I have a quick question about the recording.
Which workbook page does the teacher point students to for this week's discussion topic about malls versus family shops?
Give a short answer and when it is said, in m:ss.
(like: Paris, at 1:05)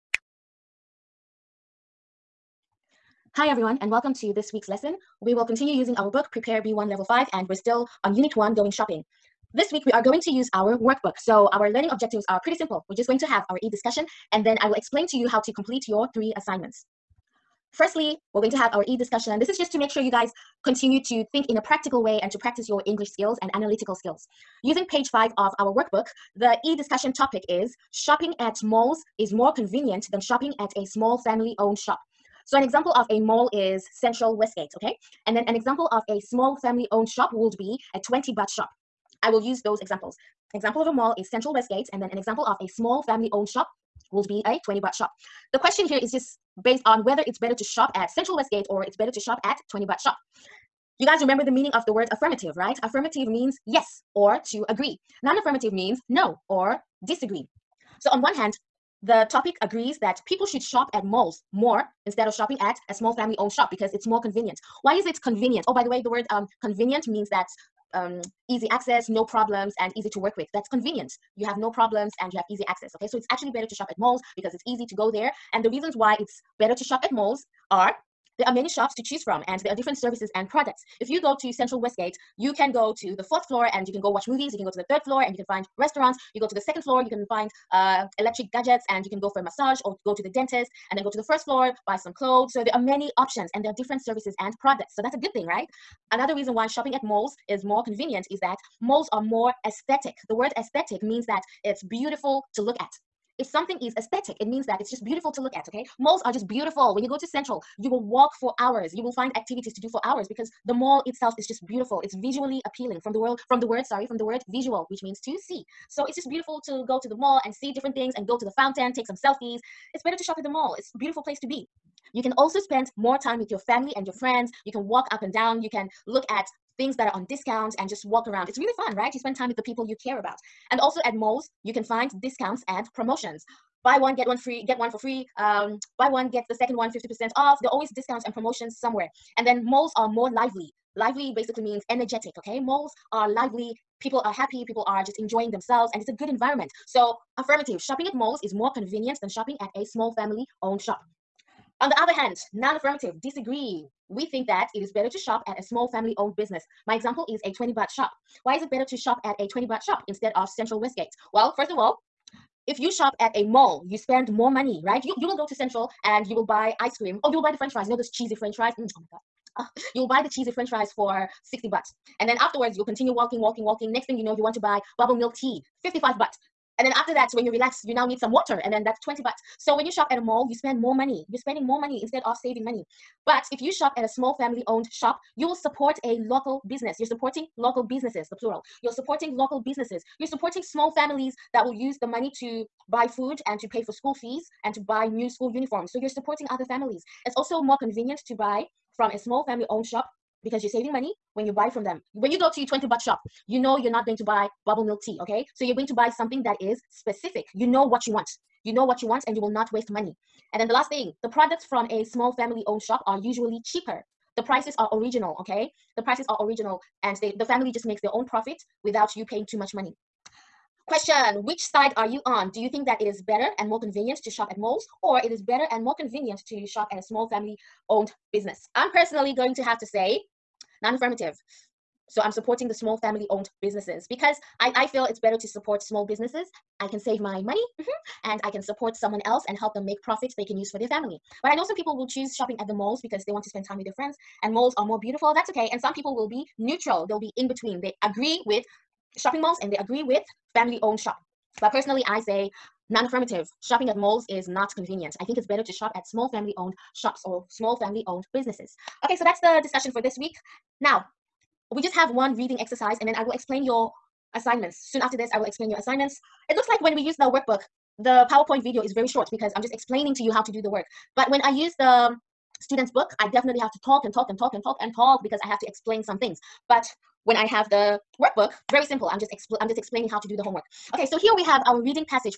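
5, at 0:24.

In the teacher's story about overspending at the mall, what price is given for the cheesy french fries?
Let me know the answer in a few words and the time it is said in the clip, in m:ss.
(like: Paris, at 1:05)
60, at 2:51.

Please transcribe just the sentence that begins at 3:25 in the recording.
So you're going to buy something that is specific.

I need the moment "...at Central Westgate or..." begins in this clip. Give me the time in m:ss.
0:47.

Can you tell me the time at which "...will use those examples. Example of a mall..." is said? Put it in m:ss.
0:39.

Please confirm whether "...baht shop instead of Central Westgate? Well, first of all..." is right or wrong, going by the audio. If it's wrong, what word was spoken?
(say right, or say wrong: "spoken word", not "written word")
right.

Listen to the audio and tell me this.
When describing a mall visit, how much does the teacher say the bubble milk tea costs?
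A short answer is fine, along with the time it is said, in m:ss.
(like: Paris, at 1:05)
55, at 2:55.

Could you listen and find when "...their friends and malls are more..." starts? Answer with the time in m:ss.
4:03.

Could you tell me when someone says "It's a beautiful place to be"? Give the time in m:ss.
2:00.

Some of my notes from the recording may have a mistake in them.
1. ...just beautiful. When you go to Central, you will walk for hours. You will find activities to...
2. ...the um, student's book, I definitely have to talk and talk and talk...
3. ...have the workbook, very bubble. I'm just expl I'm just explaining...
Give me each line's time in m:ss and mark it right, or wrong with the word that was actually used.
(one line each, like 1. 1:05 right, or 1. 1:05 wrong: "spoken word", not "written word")
1. 1:46 right
2. 4:31 right
3. 4:37 wrong: "simple", not "bubble".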